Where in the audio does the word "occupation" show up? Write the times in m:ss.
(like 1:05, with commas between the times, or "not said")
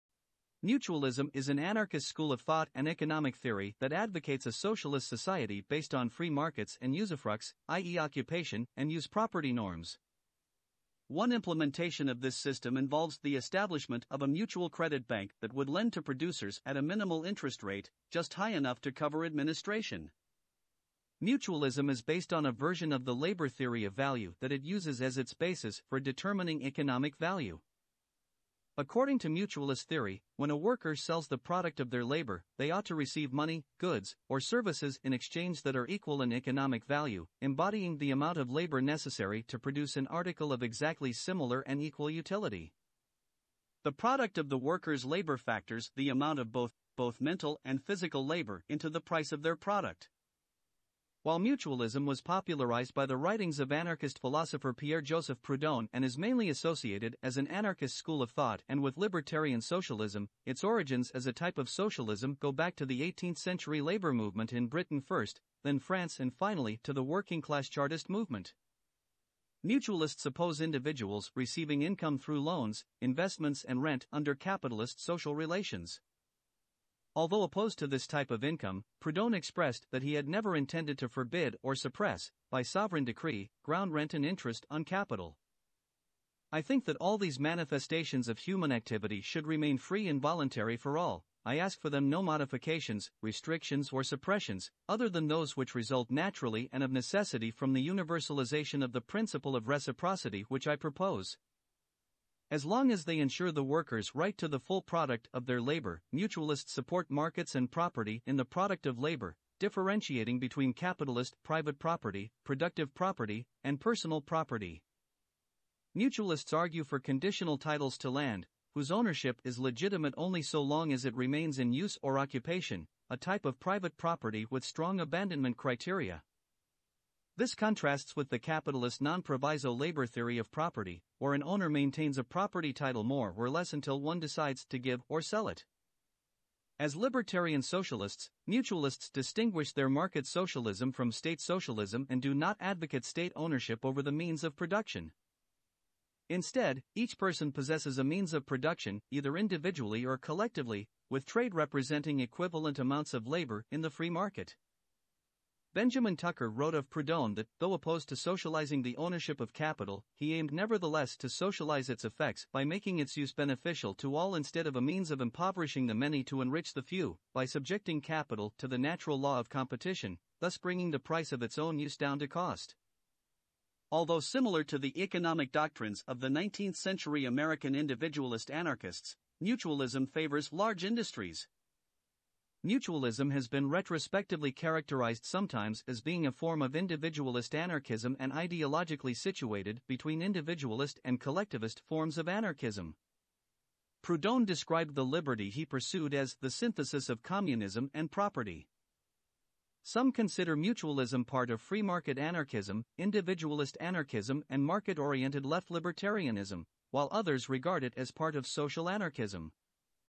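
0:07, 2:02.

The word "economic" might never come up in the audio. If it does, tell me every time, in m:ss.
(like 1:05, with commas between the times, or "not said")
0:02, 0:26, 0:36, 2:55.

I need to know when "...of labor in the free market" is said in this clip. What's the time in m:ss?
2:33.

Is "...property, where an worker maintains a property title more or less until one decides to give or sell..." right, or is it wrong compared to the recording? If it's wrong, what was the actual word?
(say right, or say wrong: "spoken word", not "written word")
wrong: "owner", not "worker".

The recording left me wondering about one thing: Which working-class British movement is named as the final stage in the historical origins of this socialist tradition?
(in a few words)
Chartist movement.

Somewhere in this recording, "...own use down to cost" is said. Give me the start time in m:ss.
2:51.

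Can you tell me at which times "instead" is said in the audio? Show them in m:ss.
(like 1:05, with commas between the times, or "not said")
2:26, 2:44.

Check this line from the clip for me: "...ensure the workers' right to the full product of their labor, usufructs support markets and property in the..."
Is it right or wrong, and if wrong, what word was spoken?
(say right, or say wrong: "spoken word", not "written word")
wrong: "mutualists", not "usufructs".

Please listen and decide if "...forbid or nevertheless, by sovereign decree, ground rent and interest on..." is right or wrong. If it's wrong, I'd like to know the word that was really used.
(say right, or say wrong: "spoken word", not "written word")
wrong: "suppress", not "nevertheless".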